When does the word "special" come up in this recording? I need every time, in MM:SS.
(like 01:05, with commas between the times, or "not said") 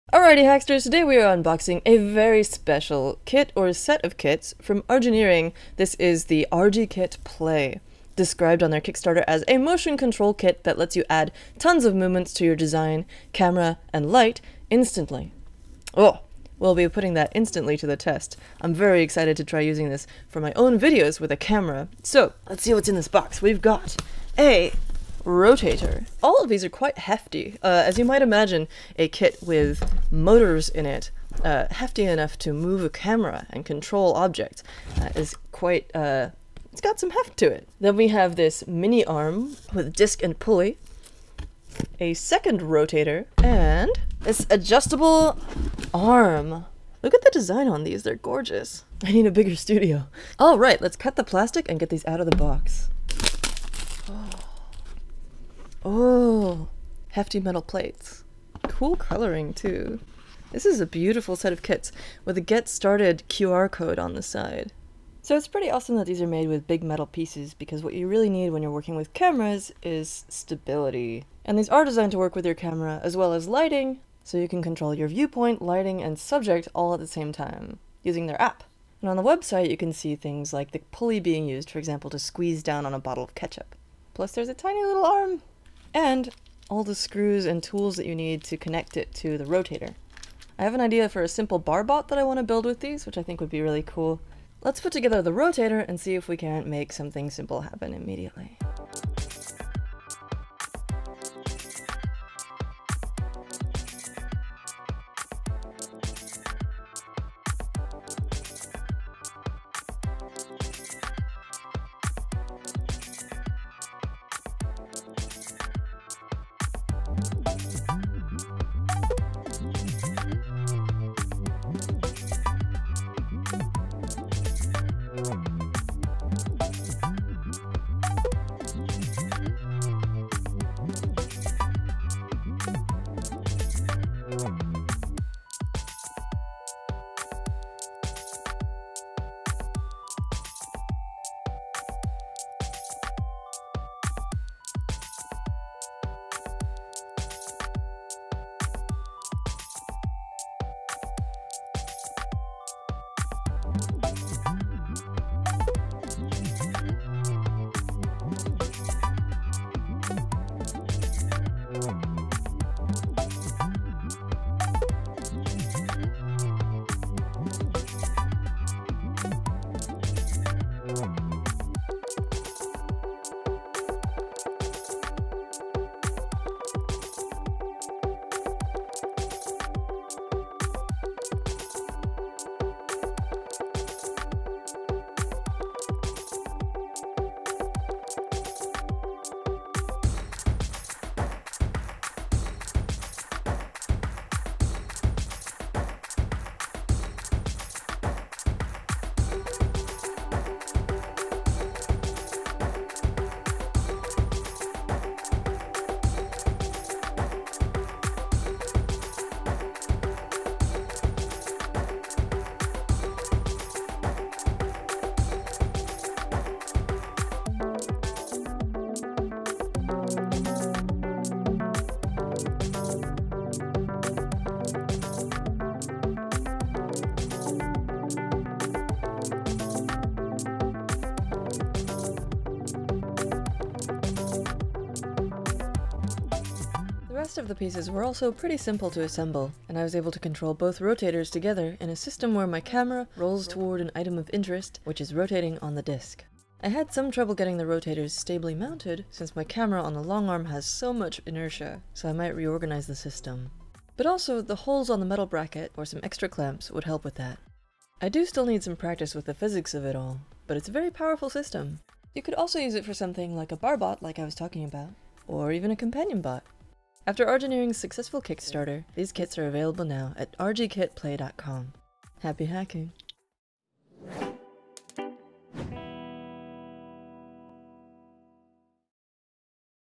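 00:02.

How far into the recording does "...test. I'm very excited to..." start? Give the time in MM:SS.
00:17.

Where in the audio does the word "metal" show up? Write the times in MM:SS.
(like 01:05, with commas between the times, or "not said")
00:57, 01:06, 04:15.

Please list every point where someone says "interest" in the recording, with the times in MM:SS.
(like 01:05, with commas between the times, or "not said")
04:04.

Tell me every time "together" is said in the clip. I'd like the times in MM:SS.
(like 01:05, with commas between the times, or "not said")
01:34, 04:01.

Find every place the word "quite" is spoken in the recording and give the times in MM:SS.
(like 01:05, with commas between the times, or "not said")
00:26, 00:35.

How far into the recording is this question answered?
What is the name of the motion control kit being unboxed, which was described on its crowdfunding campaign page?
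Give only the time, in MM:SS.
00:06.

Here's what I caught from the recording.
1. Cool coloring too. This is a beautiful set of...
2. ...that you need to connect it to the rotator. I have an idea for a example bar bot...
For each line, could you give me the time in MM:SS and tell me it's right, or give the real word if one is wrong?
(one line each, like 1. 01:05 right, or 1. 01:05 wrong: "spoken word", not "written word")
1. 00:58 right
2. 01:27 wrong: "simple", not "example".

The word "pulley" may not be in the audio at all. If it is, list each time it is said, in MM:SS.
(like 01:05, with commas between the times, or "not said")
00:40, 01:20.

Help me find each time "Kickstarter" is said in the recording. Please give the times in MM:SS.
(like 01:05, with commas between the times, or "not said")
00:08, 04:28.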